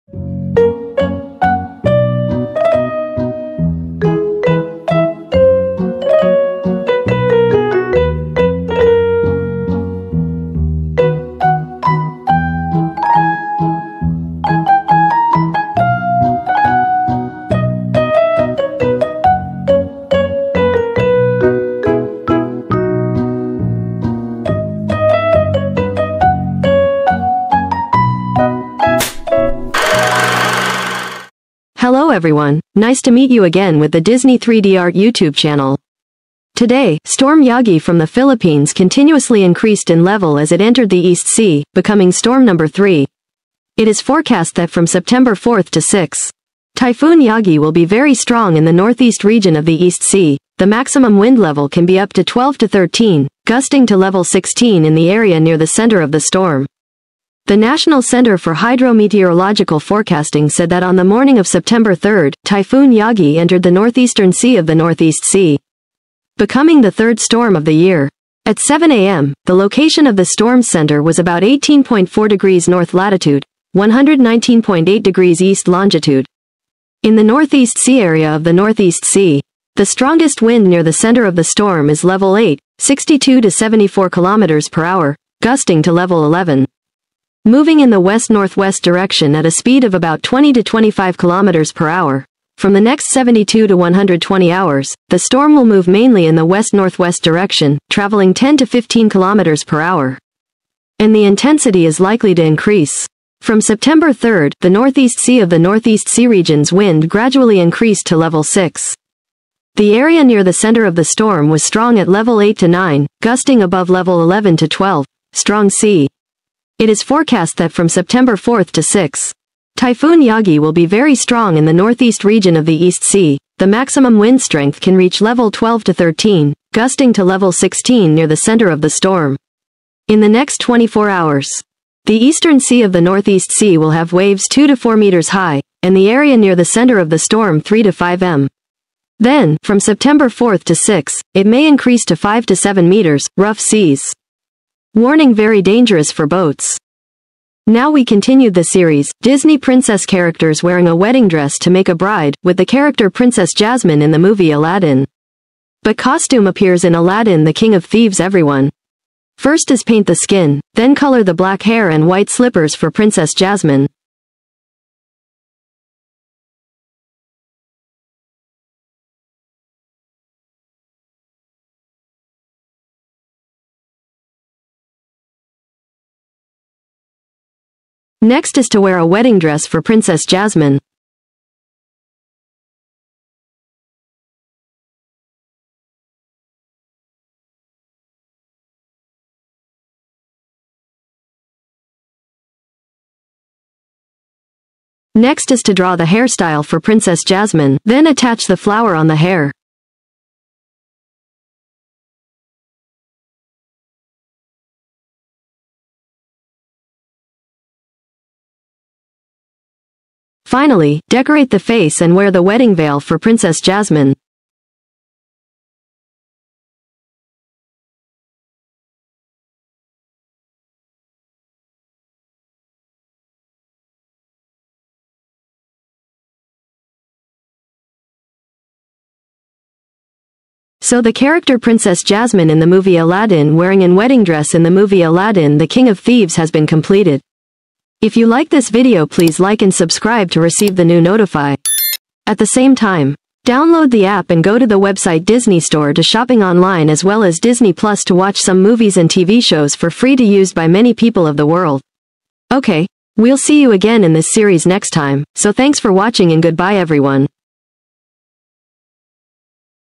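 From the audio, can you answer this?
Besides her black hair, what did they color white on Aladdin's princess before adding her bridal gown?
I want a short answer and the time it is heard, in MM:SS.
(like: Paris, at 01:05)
slippers, at 02:42.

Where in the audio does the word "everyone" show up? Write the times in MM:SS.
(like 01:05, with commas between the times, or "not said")
00:32, 02:38, 04:16.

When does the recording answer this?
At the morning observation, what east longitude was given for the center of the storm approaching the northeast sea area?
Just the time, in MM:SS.
01:13.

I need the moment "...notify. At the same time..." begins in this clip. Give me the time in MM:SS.
04:01.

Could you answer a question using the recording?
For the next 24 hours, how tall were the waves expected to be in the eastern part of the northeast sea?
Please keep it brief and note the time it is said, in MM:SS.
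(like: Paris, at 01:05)
2 to 4 meters, at 02:14.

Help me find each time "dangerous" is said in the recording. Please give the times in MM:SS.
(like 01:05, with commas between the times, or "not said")
02:25.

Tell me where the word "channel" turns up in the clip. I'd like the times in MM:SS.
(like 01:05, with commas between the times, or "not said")
00:35.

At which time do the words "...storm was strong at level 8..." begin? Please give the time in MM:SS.
01:51.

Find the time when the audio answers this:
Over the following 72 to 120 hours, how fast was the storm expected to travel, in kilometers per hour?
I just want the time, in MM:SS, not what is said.
01:38.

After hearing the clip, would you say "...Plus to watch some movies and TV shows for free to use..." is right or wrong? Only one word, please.
right.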